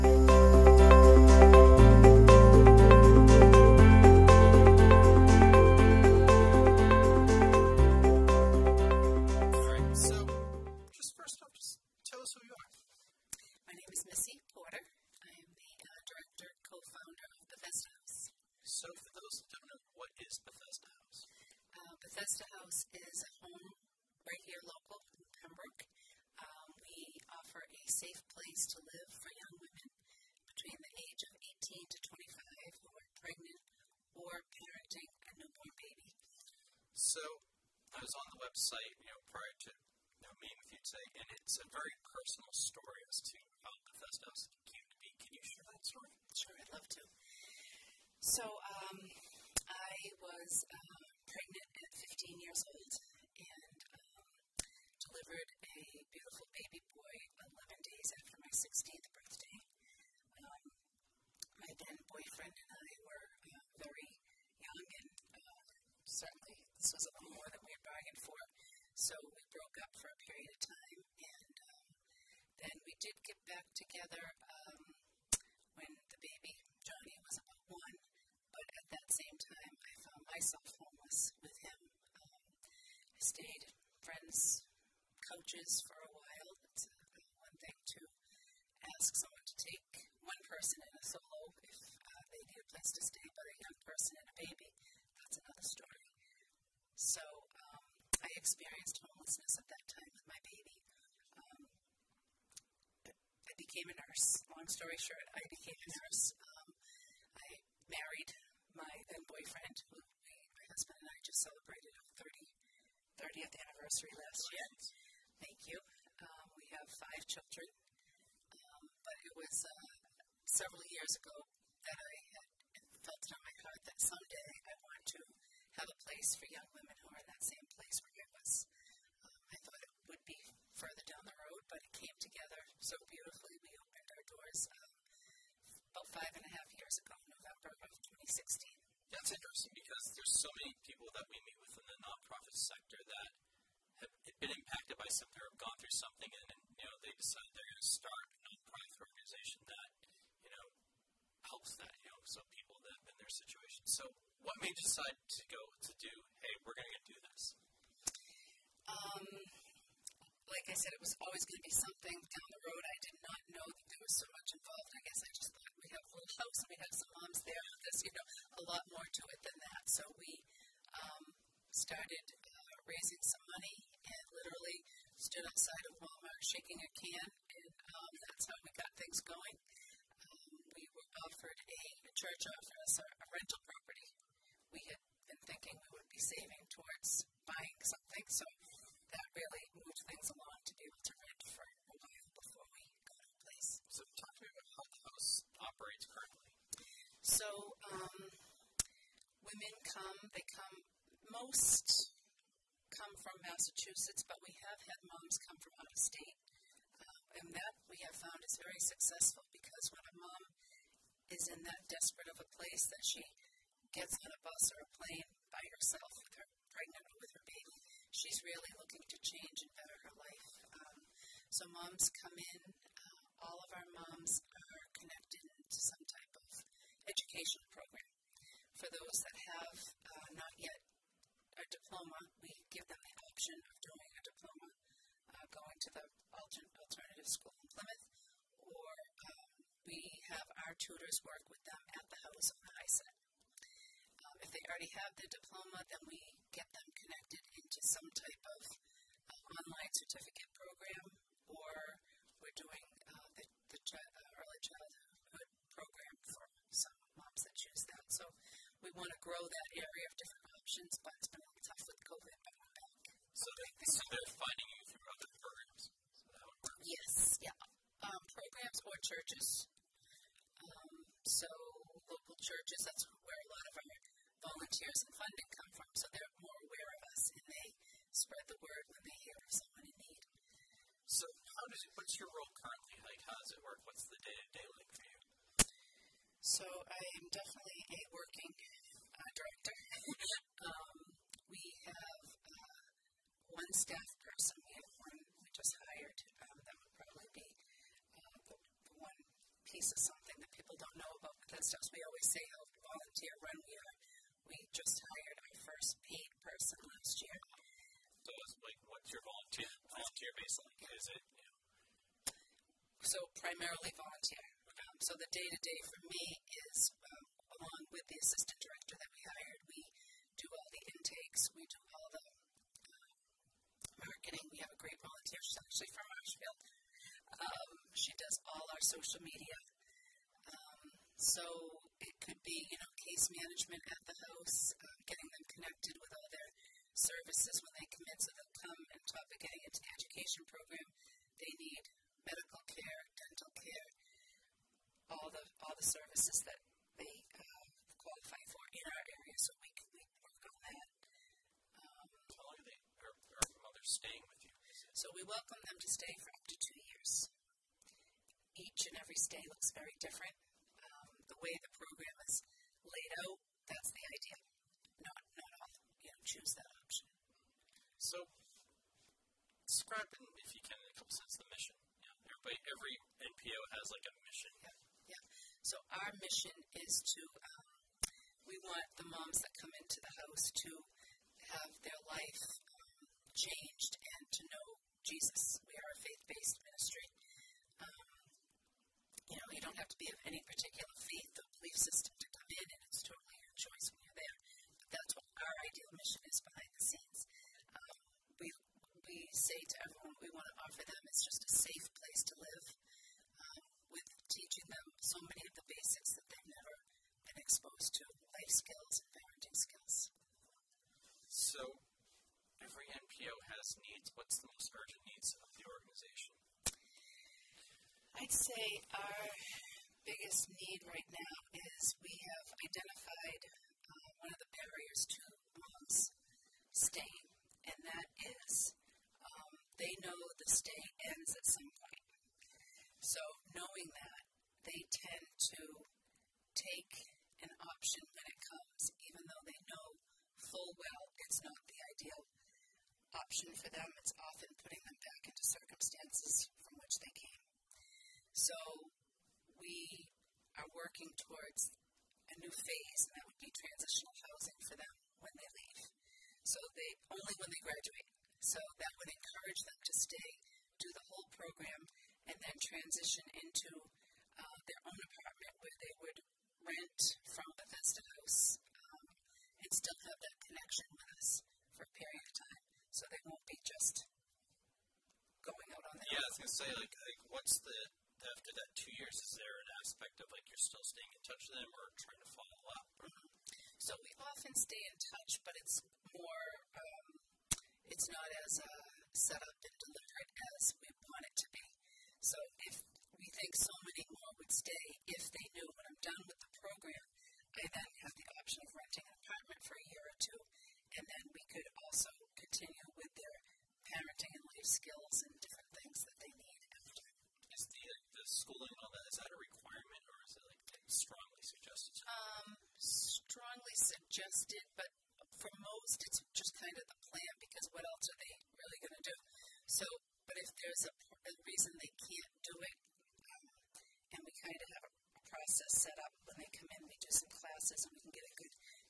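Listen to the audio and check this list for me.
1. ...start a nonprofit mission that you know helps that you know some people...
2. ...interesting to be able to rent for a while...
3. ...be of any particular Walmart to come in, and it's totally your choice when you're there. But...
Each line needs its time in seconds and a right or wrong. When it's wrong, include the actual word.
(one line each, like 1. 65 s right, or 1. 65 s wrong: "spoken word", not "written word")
1. 148 s wrong: "organization", not "mission"
2. 190 s wrong: "along", not "interesting"
3. 389 s wrong: "System", not "Walmart".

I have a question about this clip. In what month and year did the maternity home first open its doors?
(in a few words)
November 2016.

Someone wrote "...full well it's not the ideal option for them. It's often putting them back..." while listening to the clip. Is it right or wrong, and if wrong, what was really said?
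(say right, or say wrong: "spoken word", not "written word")
right.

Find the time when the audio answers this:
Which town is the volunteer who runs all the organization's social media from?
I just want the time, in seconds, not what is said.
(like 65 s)
326 s.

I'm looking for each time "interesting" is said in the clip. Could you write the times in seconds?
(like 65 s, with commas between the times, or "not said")
139 s.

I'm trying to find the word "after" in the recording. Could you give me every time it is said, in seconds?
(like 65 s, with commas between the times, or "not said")
58 s, 478 s, 506 s.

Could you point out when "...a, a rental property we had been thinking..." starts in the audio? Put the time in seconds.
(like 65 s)
182 s.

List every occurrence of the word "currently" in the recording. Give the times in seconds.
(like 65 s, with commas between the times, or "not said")
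196 s, 282 s.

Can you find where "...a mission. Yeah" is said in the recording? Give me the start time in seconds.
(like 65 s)
374 s.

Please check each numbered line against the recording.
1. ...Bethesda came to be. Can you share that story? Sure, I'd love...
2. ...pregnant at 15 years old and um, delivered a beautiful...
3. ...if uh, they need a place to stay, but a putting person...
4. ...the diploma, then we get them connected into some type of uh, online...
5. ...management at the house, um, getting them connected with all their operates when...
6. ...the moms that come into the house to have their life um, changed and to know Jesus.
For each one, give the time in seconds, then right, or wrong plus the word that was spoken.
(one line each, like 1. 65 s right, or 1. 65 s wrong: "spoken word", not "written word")
1. 43 s right
2. 51 s right
3. 91 s wrong: "young", not "putting"
4. 245 s right
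5. 333 s wrong: "services", not "operates"
6. 379 s right.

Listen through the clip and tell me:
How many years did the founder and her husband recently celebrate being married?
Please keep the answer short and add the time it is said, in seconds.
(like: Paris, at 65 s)
30, at 113 s.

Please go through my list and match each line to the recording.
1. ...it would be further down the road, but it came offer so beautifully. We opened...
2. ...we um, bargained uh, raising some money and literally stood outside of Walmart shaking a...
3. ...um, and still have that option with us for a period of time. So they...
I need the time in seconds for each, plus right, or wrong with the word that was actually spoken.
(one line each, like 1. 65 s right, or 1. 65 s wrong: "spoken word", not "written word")
1. 129 s wrong: "together", not "offer"
2. 170 s wrong: "started", not "bargained"
3. 468 s wrong: "connection", not "option".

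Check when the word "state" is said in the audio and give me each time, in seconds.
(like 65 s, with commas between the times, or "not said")
206 s, 430 s.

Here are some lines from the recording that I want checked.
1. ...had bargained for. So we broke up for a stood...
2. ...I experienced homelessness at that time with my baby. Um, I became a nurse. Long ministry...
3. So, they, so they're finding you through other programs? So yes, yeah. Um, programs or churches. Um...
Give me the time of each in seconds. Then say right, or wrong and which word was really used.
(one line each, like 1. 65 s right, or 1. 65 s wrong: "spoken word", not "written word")
1. 67 s wrong: "period", not "stood"
2. 98 s wrong: "story", not "ministry"
3. 263 s right.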